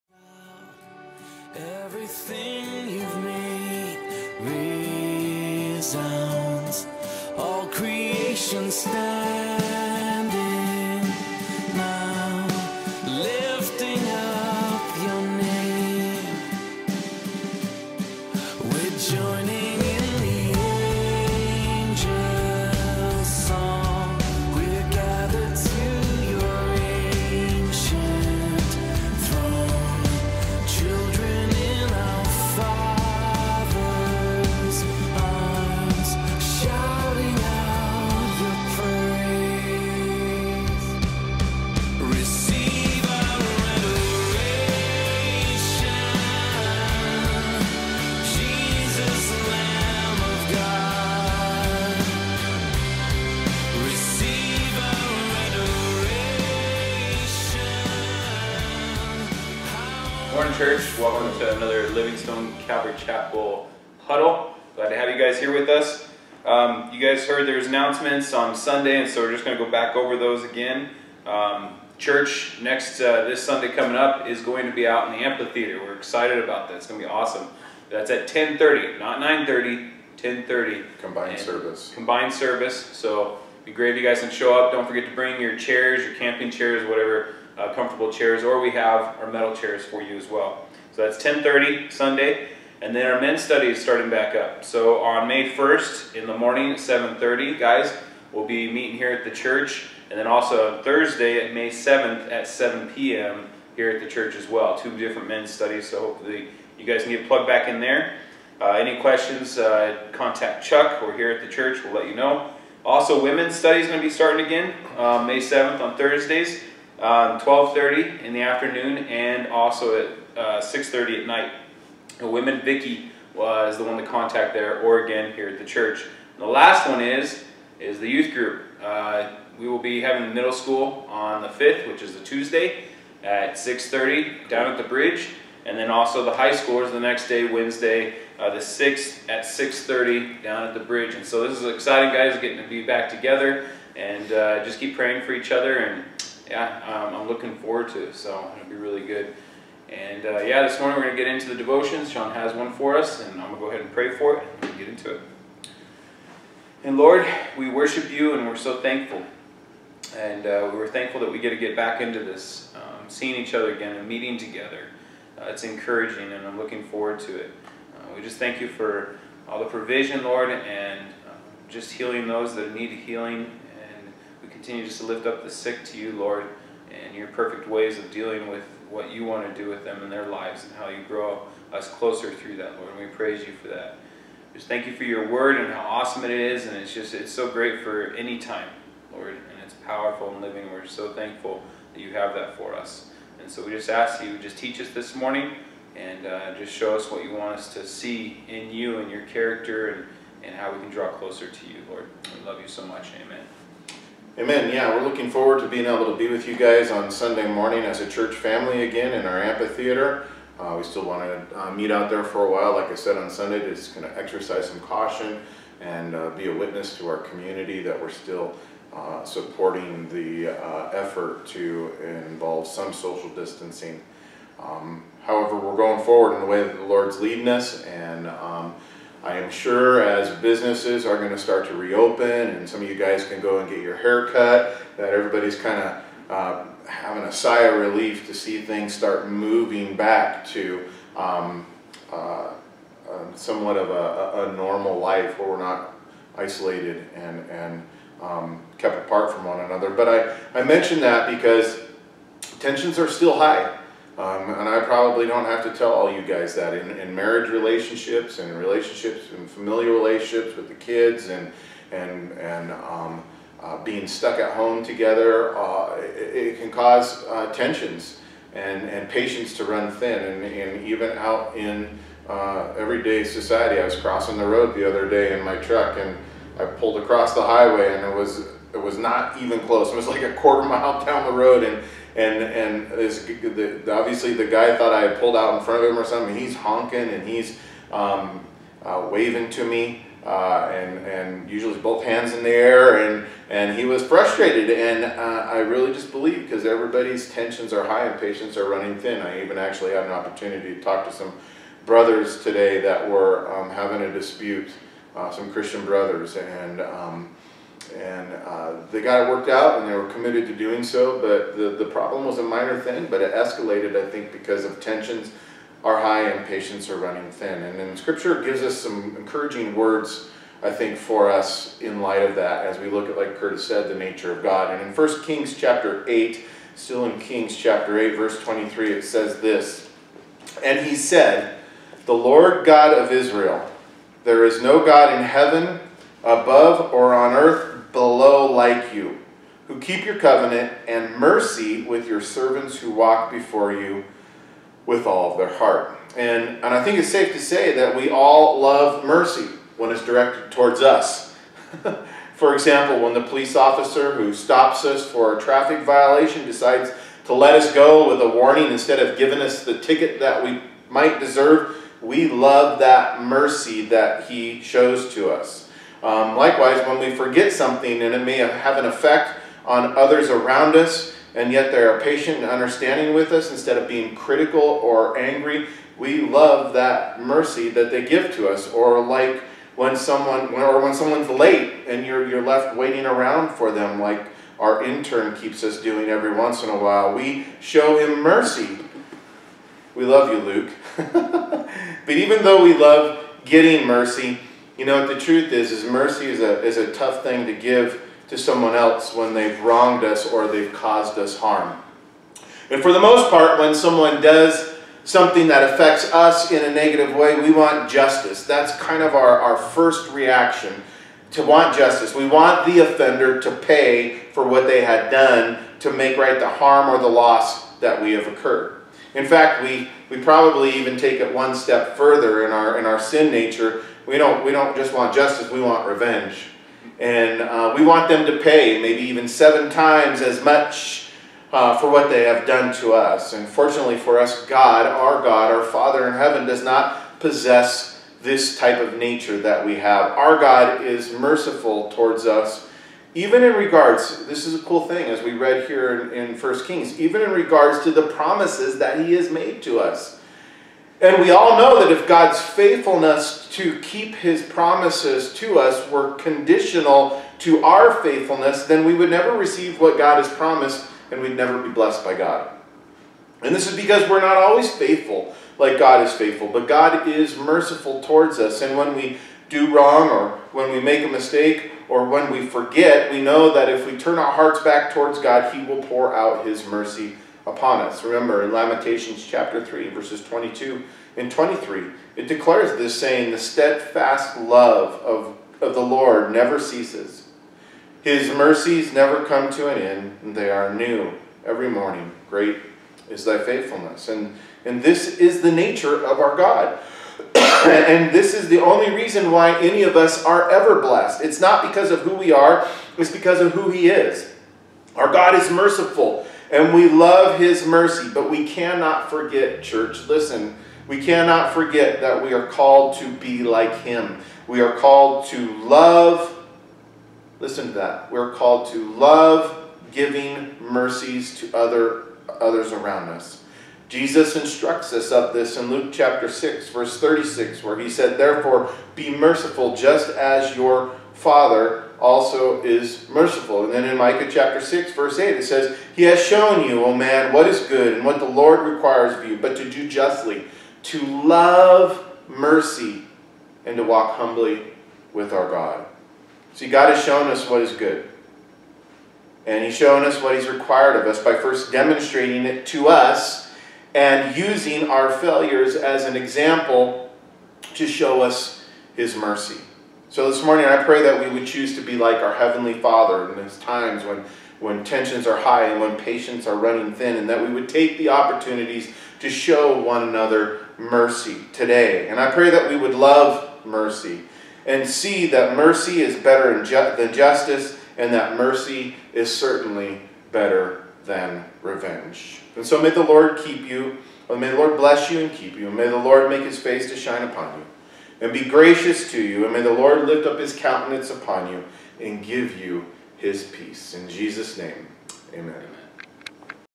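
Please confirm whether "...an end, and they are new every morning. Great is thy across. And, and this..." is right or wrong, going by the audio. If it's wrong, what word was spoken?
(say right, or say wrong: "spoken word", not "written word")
wrong: "faithfulness", not "across".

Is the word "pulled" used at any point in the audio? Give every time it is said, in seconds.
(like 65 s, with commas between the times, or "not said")
276 s, 285 s.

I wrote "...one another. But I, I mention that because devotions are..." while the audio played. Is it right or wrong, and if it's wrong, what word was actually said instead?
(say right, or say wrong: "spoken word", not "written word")
wrong: "tensions", not "devotions".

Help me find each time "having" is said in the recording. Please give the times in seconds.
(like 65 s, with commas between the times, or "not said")
130 s, 236 s, 303 s.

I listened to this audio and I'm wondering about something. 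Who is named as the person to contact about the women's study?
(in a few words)
Vicky.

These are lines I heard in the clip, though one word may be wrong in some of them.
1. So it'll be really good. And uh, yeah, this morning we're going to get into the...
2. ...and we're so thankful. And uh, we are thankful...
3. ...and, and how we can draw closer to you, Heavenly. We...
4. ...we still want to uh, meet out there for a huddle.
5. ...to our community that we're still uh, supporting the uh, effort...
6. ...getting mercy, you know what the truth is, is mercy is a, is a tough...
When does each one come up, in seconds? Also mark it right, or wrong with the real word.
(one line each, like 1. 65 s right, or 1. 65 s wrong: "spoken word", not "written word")
1. 148 s right
2. 158 s right
3. 200 s wrong: "Lord", not "Heavenly"
4. 210 s wrong: "while", not "huddle"
5. 216 s right
6. 393 s right.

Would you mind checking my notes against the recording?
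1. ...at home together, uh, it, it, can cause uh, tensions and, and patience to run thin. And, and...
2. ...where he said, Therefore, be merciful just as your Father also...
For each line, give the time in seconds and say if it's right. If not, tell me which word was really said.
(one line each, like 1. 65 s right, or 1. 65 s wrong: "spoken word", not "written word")
1. 264 s right
2. 527 s right.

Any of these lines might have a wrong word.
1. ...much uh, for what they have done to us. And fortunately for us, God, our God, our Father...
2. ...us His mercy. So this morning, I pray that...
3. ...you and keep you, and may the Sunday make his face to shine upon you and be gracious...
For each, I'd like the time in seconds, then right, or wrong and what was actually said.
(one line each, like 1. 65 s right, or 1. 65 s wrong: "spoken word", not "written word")
1. 430 s right
2. 558 s right
3. 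585 s wrong: "Lord", not "Sunday".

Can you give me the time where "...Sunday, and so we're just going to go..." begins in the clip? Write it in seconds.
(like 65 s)
68 s.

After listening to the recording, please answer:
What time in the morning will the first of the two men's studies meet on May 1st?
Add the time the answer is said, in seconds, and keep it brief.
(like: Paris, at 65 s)
7:30, at 96 s.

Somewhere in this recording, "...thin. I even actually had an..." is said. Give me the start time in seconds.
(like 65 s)
298 s.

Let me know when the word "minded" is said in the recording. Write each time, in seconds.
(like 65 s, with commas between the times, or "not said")
not said.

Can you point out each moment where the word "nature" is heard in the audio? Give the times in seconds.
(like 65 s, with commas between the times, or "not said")
323 s, 423 s, 438 s, 495 s.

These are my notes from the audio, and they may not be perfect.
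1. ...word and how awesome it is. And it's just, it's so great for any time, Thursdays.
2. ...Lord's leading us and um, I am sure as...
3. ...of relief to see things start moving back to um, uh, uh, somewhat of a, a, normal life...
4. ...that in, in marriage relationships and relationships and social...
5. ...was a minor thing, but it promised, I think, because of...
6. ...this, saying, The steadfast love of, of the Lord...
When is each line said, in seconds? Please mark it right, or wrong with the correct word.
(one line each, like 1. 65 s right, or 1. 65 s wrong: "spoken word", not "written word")
1. 185 s wrong: "Lord", not "Thursdays"
2. 226 s right
3. 237 s right
4. 256 s wrong: "familial", not "social"
5. 312 s wrong: "escalated", not "promised"
6. 482 s right.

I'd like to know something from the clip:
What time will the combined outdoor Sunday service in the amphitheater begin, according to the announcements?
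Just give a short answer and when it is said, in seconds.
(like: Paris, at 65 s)
10:30, at 78 s.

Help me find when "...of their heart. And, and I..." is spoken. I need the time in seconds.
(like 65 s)
345 s.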